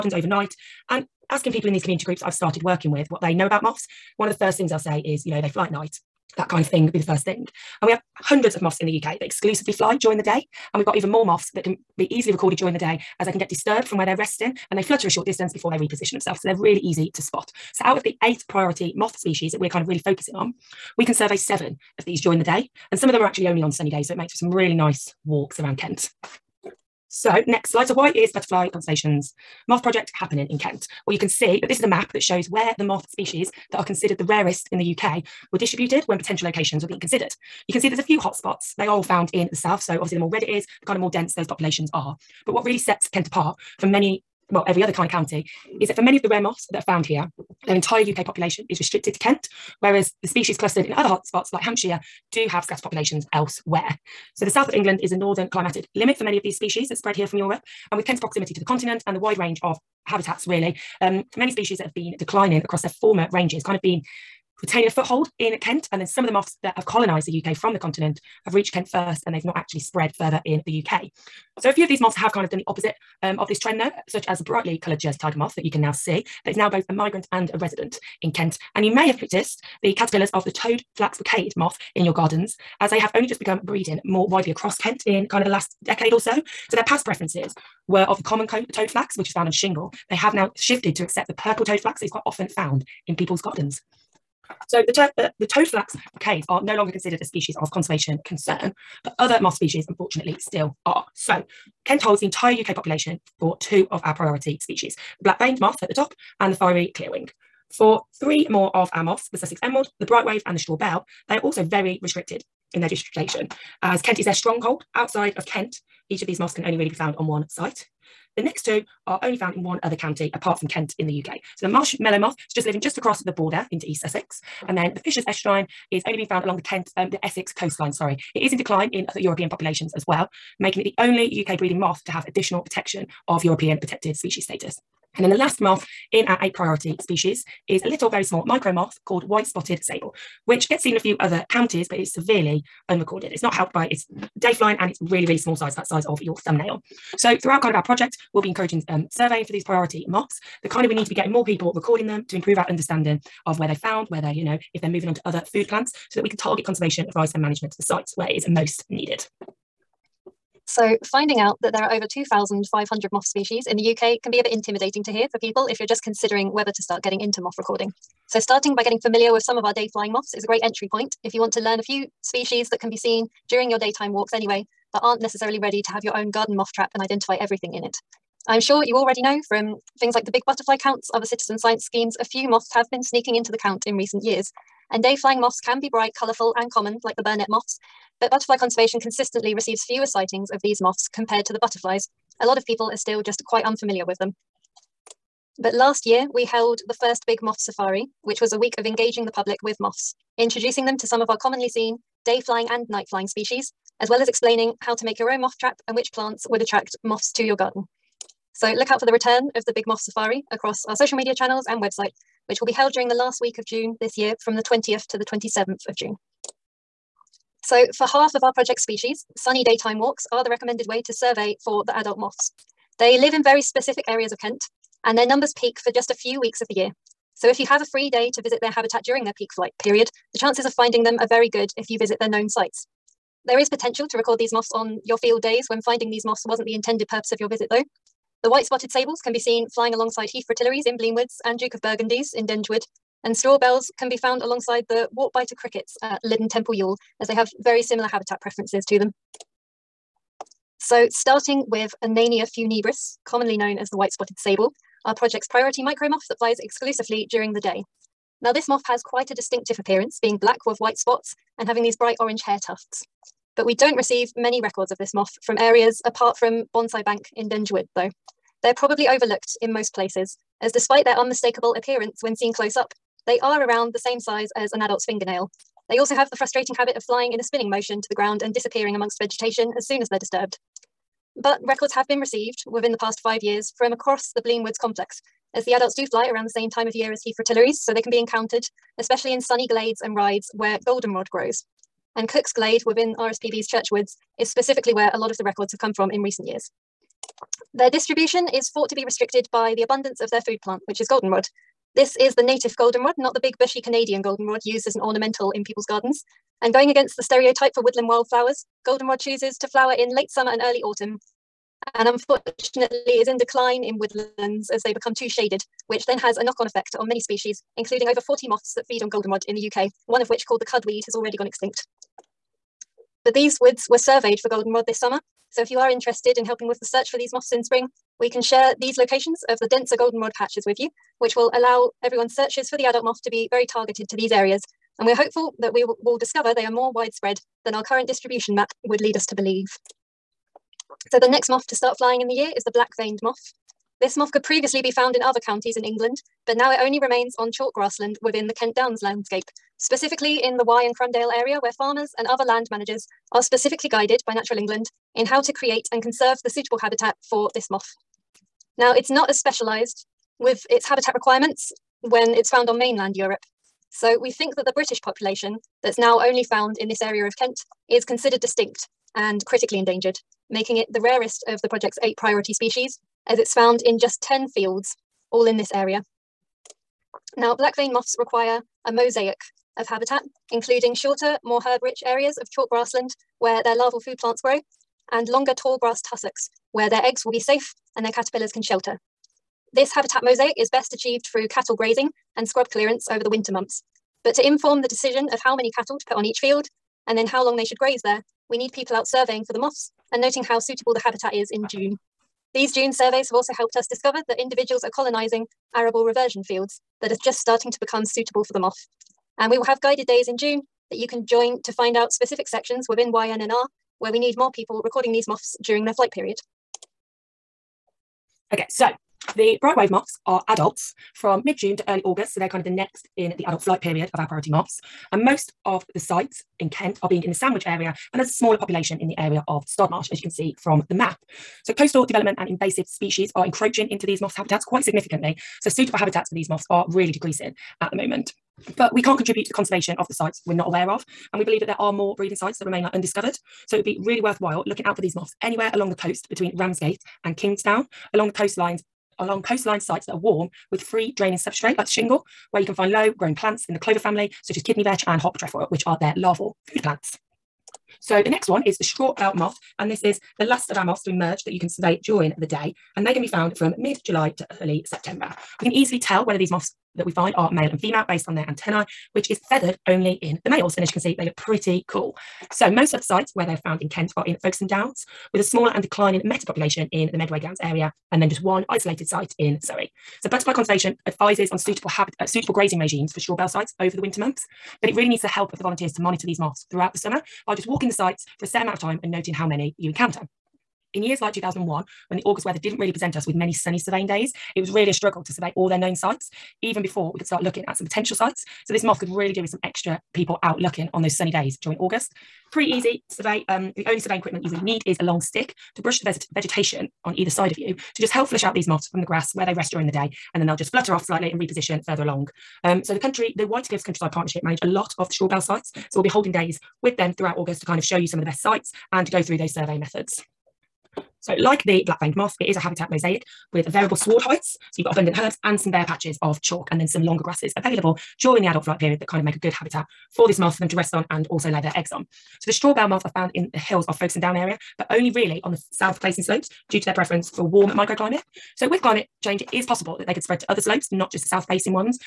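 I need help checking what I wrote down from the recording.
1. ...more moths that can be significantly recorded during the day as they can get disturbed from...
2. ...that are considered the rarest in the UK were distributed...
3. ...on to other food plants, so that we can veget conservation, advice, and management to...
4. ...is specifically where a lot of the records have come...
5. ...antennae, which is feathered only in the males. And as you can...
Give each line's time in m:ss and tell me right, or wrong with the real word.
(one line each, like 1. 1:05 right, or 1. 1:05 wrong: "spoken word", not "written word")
1. 0:11 wrong: "easily", not "significantly"
2. 0:33 right
3. 2:35 wrong: "target", not "veget"
4. 4:54 right
5. 7:48 right.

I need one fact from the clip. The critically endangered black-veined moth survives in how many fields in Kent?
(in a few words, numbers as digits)
10.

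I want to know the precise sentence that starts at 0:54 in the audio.
So the south of England is a northern climatic limit for many of these species that spread here from Europe.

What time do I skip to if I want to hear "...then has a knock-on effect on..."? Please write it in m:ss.
5:16.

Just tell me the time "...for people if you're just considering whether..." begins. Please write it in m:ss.
2:45.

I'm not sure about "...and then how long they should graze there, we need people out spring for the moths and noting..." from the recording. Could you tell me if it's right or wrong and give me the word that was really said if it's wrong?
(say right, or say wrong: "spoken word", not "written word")
wrong: "surveying", not "spring".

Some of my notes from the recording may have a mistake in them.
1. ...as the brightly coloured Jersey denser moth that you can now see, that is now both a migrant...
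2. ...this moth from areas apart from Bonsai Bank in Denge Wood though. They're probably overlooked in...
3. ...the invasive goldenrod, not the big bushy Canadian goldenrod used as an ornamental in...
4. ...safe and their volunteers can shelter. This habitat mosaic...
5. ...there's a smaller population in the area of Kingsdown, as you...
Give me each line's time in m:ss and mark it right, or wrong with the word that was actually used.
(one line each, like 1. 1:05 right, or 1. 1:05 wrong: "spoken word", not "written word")
1. 1:14 wrong: "tiger", not "denser"
2. 4:25 right
3. 5:02 wrong: "native", not "invasive"
4. 6:27 wrong: "caterpillars", not "volunteers"
5. 7:08 wrong: "Stodmarsh", not "Kingsdown".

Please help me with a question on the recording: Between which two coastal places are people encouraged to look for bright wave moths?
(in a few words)
Ramsgate and Kingsdown.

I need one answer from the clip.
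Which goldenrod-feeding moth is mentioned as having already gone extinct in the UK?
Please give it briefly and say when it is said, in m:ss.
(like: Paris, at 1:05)
The cudweed, at 5:20.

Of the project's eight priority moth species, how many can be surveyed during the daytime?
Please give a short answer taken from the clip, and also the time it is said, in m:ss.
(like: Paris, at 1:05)
7, at 0:21.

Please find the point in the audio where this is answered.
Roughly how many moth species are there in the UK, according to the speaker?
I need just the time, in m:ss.
2:41.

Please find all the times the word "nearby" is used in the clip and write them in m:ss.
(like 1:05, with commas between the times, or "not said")
not said.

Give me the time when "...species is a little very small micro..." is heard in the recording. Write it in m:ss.
2:16.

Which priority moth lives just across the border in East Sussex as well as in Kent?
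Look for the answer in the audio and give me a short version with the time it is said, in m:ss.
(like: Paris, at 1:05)
Marshmallow moth, at 2:01.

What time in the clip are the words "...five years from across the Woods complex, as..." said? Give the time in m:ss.
4:43.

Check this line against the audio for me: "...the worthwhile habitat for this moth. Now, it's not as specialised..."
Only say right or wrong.
wrong.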